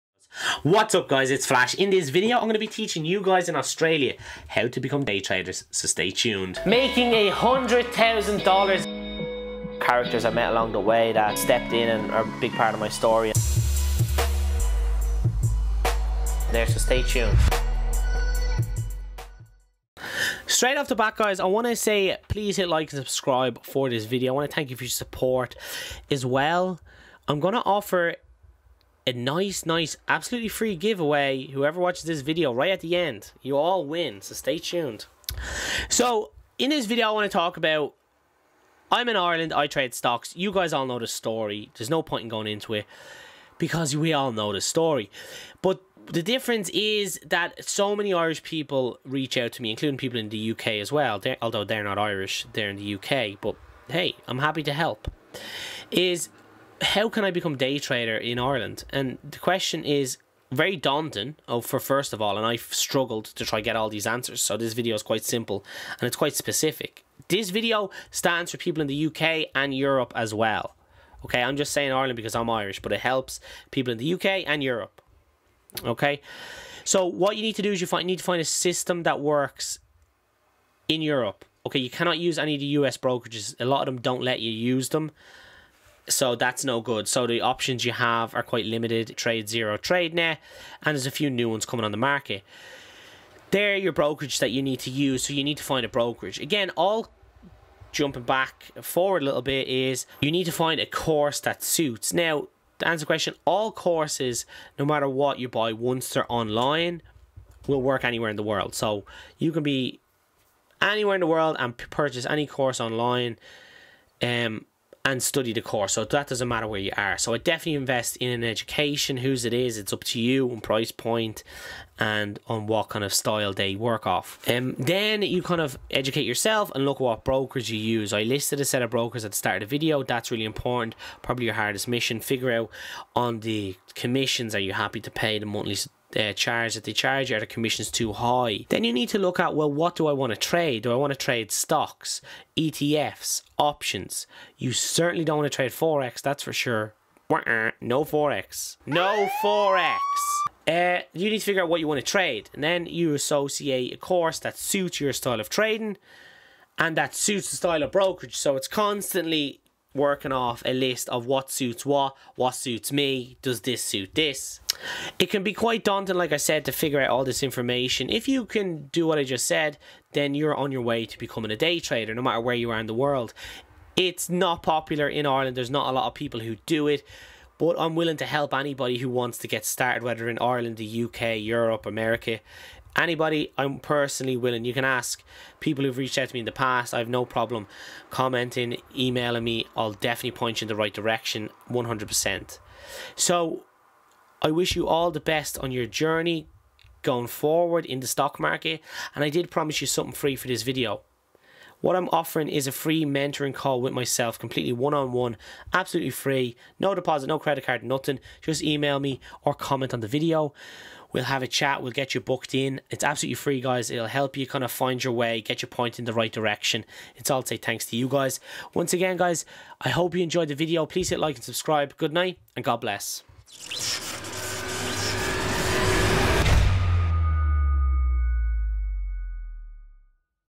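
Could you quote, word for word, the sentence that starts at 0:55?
Is how can I become day trader in Ireland?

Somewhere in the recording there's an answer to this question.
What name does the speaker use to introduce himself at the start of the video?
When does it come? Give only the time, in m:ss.
0:01.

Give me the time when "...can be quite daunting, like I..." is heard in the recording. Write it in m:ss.
2:45.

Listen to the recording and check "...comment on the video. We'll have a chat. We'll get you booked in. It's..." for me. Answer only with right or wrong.
right.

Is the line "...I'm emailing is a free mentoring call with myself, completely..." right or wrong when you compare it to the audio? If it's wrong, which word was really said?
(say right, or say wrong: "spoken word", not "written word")
wrong: "offering", not "emailing".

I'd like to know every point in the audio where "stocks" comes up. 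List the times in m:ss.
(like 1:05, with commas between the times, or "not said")
0:39, 2:21, 3:18.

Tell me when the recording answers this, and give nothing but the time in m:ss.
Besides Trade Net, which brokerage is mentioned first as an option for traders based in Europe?
1:29.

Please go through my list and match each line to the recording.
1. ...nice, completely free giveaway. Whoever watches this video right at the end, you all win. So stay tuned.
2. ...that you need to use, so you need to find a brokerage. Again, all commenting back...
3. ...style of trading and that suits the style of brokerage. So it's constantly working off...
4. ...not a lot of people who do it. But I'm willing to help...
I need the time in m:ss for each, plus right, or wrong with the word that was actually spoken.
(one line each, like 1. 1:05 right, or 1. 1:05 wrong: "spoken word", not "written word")
1. 0:29 wrong: "absolutely", not "completely"
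2. 1:34 wrong: "jumping", not "commenting"
3. 2:35 right
4. 2:55 right.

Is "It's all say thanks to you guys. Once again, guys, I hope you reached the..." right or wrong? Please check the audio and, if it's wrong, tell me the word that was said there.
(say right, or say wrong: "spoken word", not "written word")
wrong: "enjoyed", not "reached".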